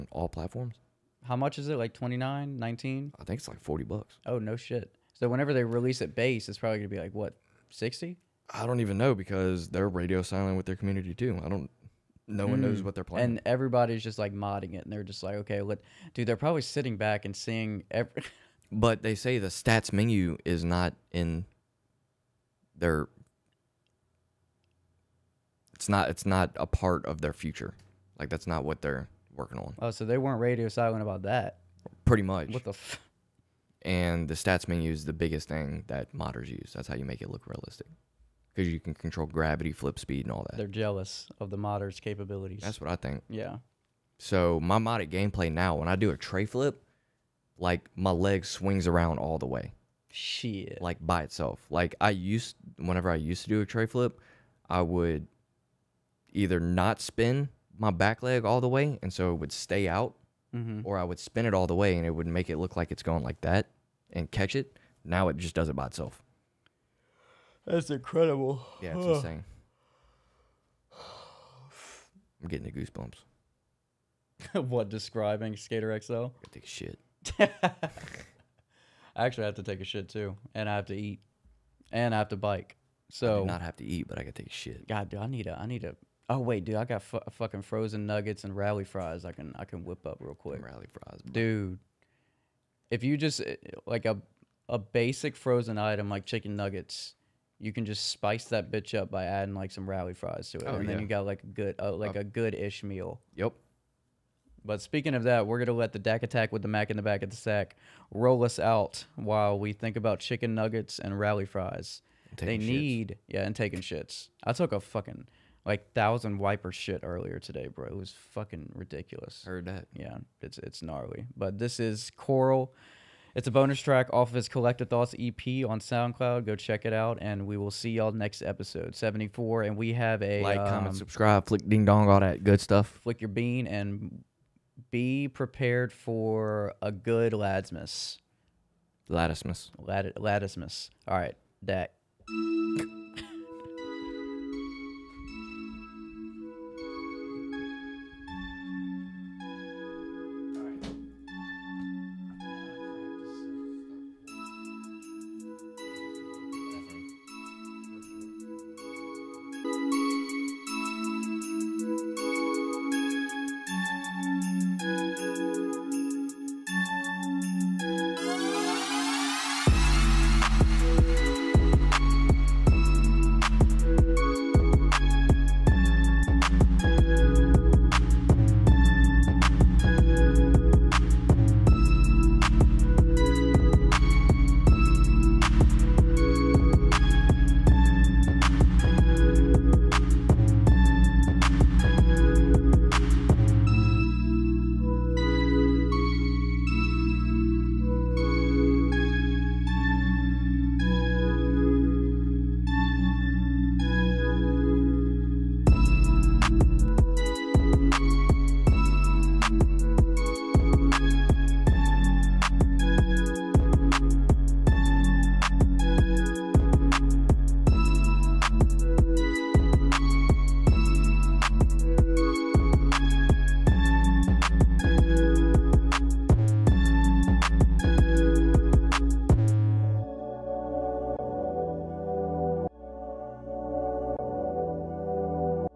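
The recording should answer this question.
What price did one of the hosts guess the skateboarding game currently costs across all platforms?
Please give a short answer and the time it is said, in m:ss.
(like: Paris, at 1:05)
$40, at 0:03.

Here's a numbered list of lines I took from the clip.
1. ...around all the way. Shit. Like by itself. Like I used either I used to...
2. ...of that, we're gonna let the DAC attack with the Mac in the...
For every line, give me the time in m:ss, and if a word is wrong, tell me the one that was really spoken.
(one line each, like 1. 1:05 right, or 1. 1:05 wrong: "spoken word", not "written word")
1. 0:48 wrong: "whenever", not "either"
2. 1:45 right.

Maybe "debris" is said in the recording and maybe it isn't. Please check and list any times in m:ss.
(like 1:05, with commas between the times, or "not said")
not said.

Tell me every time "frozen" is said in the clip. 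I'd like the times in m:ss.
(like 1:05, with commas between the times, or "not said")
1:27, 1:35.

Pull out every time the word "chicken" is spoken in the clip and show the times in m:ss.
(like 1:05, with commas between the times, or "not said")
1:36, 1:50.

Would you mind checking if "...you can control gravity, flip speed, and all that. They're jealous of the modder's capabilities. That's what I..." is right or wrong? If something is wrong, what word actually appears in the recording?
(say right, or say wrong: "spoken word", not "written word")
right.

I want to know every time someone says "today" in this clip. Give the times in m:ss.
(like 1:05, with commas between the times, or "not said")
1:57.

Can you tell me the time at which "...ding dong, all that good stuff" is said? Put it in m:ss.
2:11.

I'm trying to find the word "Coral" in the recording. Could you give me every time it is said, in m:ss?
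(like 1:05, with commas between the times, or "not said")
2:02.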